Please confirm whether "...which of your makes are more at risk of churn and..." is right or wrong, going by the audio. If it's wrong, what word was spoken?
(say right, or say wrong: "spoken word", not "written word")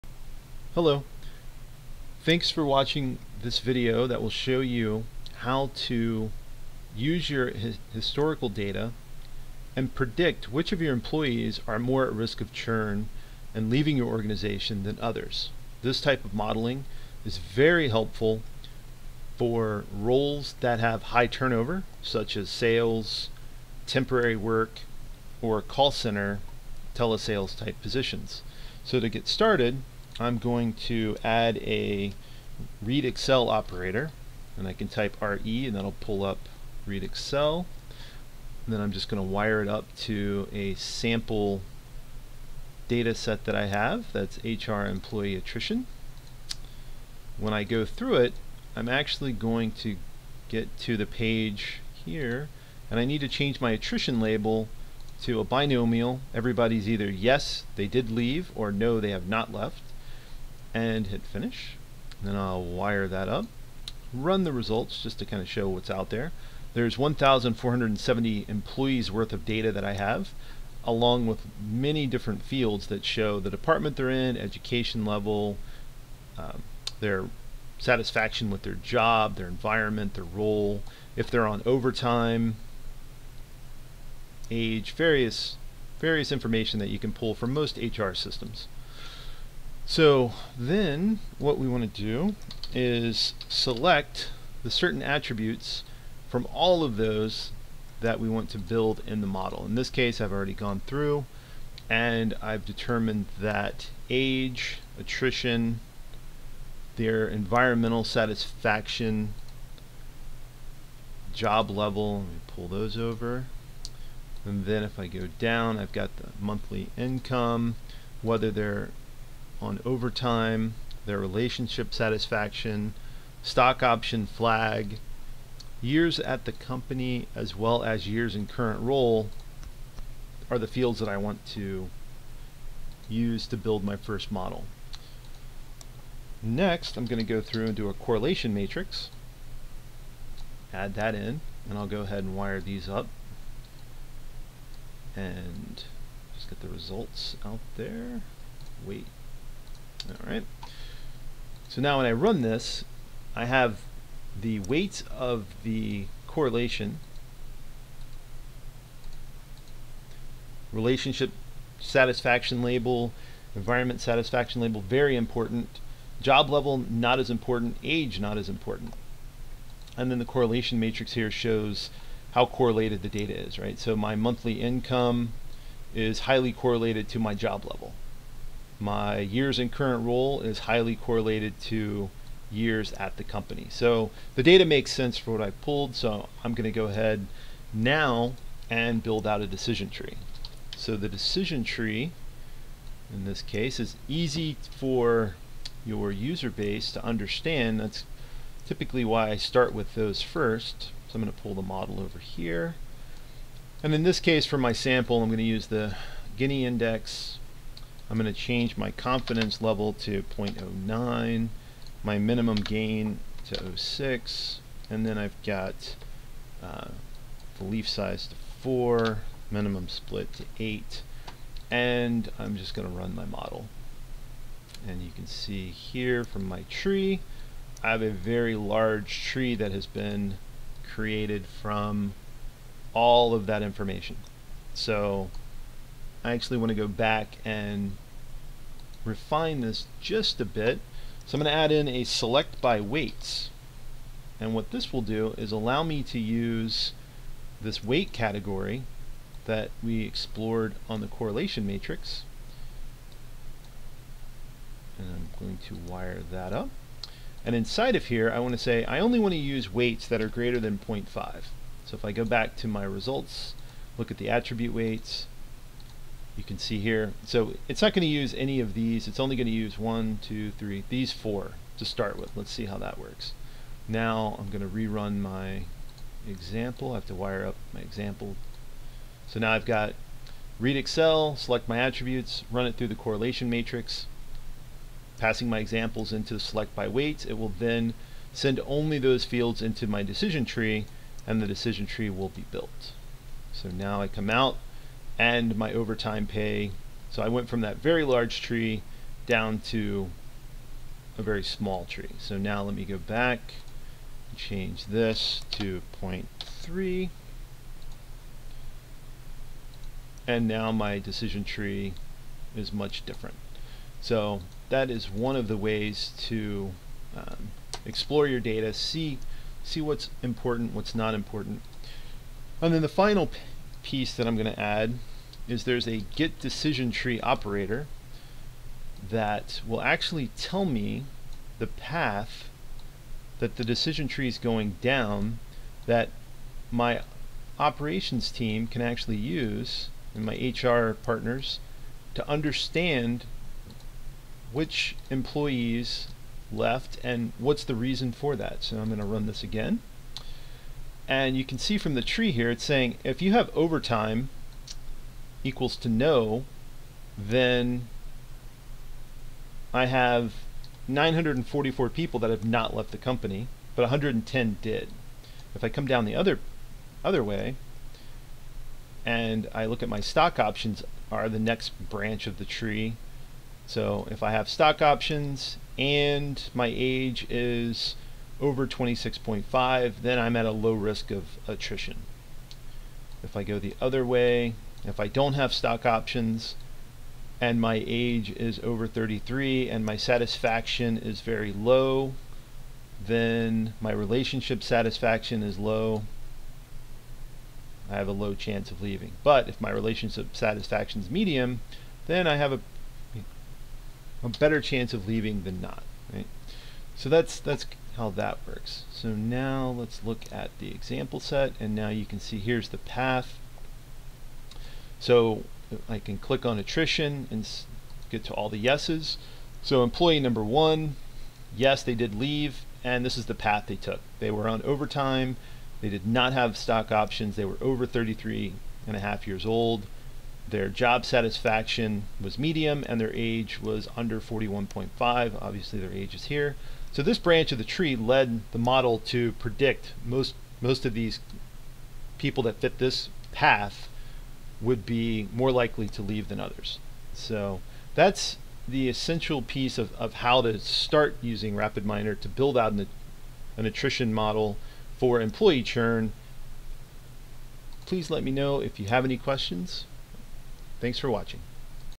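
wrong: "employees", not "makes".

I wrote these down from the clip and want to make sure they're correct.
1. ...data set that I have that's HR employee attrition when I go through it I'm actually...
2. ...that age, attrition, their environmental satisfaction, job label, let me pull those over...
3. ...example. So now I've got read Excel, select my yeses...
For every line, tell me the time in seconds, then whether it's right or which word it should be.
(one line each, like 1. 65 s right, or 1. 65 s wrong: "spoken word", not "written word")
1. 42 s right
2. 103 s wrong: "level", not "label"
3. 277 s wrong: "attributes", not "yeses".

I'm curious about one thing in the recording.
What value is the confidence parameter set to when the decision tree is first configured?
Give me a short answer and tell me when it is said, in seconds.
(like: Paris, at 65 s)
0.09, at 210 s.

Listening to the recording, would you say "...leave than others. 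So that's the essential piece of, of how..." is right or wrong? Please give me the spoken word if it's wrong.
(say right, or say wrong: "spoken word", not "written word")
right.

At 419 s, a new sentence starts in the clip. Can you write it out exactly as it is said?
So employee number one, yes, they did leave, and this is the path they took.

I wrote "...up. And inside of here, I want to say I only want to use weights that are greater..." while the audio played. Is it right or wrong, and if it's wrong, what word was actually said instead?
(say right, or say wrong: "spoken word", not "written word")
right.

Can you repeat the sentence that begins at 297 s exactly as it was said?
So I went from that very large tree down to a very small tree.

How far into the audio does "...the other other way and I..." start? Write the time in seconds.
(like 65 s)
366 s.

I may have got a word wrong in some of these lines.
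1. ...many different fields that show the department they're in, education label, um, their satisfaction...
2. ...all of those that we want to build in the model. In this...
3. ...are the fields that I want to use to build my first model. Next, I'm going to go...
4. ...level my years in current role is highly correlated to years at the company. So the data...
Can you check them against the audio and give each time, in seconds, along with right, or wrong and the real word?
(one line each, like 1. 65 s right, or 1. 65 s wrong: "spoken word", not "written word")
1. 71 s wrong: "level", not "label"
2. 96 s right
3. 130 s right
4. 177 s right.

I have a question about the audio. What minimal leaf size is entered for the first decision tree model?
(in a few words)
4.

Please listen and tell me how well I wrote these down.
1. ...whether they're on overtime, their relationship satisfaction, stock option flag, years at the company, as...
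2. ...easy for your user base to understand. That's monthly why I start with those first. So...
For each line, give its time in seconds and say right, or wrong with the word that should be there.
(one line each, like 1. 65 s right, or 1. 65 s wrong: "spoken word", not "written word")
1. 118 s right
2. 194 s wrong: "typically", not "monthly".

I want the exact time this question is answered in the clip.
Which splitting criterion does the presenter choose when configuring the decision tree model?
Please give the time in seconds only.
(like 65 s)
206 s.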